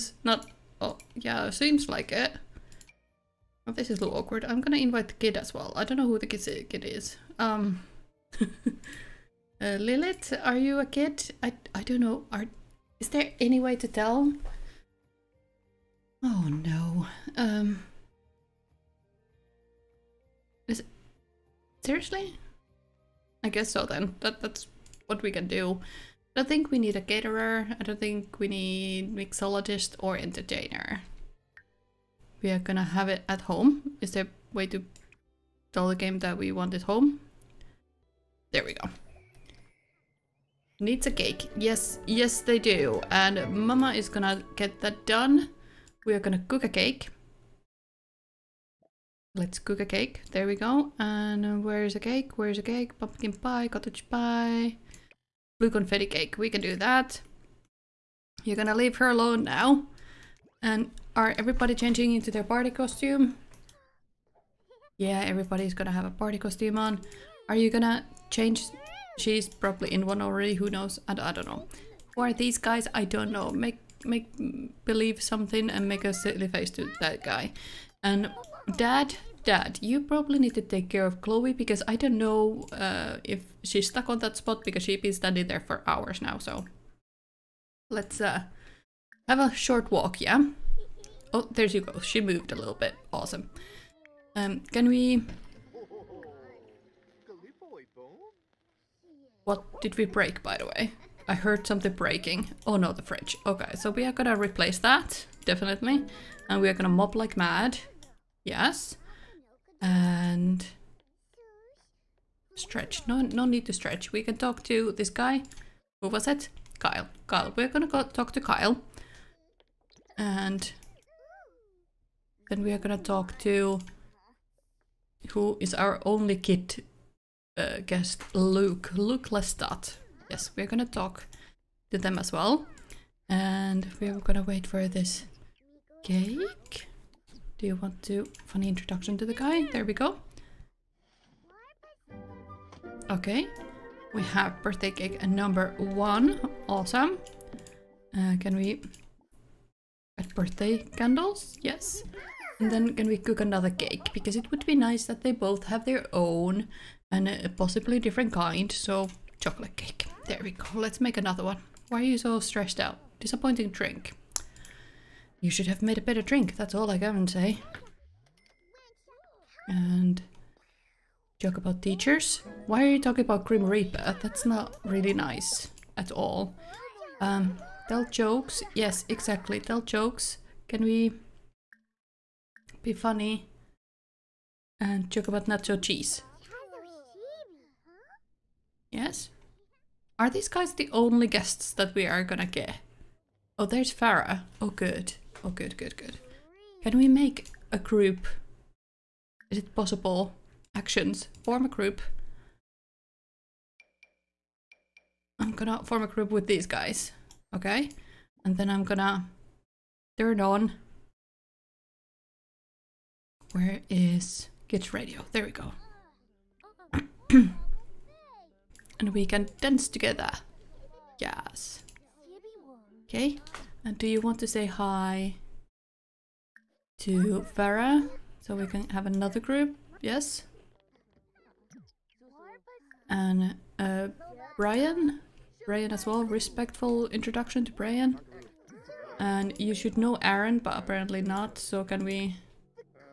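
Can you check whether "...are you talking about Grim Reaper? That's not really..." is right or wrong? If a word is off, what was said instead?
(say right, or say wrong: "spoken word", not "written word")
right.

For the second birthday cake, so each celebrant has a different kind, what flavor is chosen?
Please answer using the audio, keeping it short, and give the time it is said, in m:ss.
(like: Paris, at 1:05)
Chocolate, at 2:39.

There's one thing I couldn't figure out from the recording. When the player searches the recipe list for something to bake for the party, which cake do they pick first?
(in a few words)
Blue confetti cake.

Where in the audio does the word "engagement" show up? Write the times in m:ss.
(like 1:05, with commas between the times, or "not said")
not said.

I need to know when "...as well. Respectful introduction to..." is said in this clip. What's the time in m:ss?
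3:55.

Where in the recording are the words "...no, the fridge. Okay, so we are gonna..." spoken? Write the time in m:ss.
1:42.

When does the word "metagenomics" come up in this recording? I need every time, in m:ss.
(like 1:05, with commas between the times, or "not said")
not said.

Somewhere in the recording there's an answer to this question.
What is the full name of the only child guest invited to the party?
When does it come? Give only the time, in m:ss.
2:08.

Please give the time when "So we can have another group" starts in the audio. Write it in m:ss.
3:48.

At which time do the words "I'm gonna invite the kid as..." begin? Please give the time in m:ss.
0:04.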